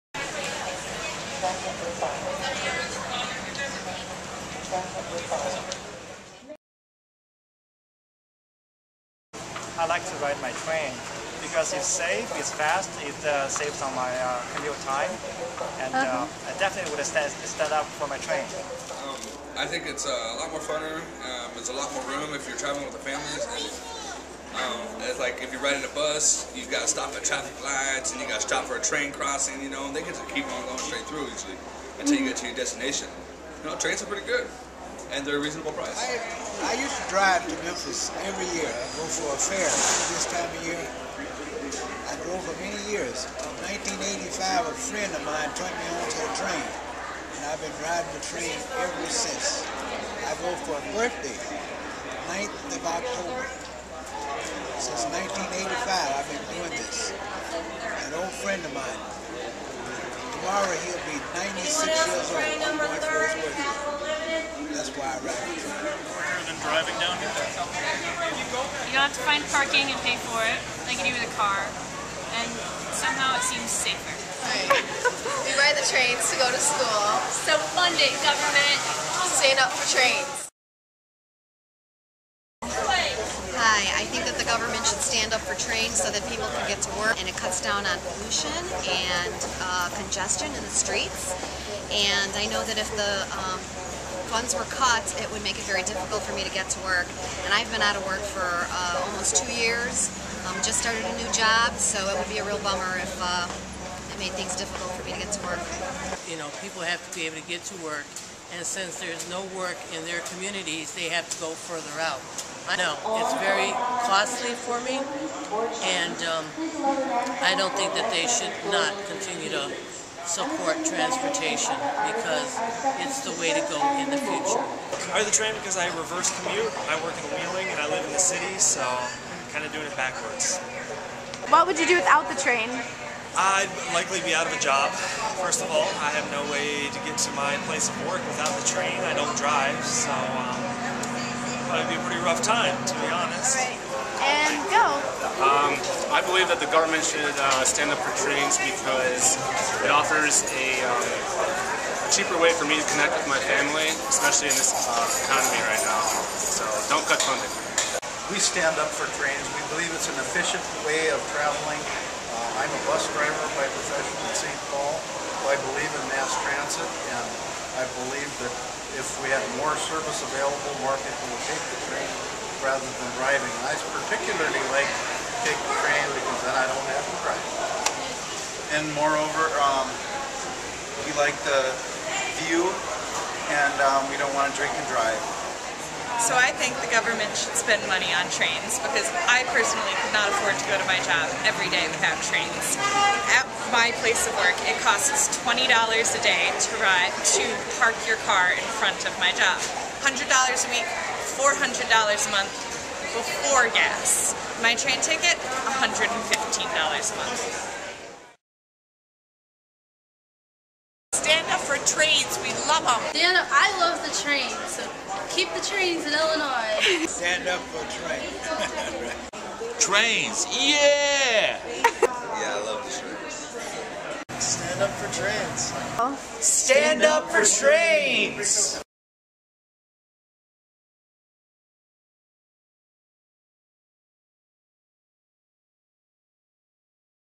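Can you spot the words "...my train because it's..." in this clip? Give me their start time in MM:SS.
00:10.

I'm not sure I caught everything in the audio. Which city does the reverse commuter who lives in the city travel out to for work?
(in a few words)
Wheeling.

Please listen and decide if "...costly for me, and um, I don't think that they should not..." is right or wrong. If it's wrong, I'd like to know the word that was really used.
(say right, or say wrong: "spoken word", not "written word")
right.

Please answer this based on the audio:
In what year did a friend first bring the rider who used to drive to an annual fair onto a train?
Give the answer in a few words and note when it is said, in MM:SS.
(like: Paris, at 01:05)
1985, at 00:43.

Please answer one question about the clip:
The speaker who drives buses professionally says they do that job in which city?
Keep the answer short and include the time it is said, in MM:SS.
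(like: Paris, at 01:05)
St. Paul, at 02:44.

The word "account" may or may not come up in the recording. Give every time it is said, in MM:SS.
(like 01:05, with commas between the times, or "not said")
not said.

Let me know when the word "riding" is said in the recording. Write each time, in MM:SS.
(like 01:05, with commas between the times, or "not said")
00:25, 00:47.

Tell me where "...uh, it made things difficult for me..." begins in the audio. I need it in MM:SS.
01:43.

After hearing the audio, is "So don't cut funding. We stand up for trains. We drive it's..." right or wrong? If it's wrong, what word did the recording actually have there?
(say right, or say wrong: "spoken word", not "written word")
wrong: "believe", not "drive".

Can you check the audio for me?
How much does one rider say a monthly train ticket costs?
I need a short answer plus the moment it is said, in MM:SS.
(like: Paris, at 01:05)
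$115, at 03:25.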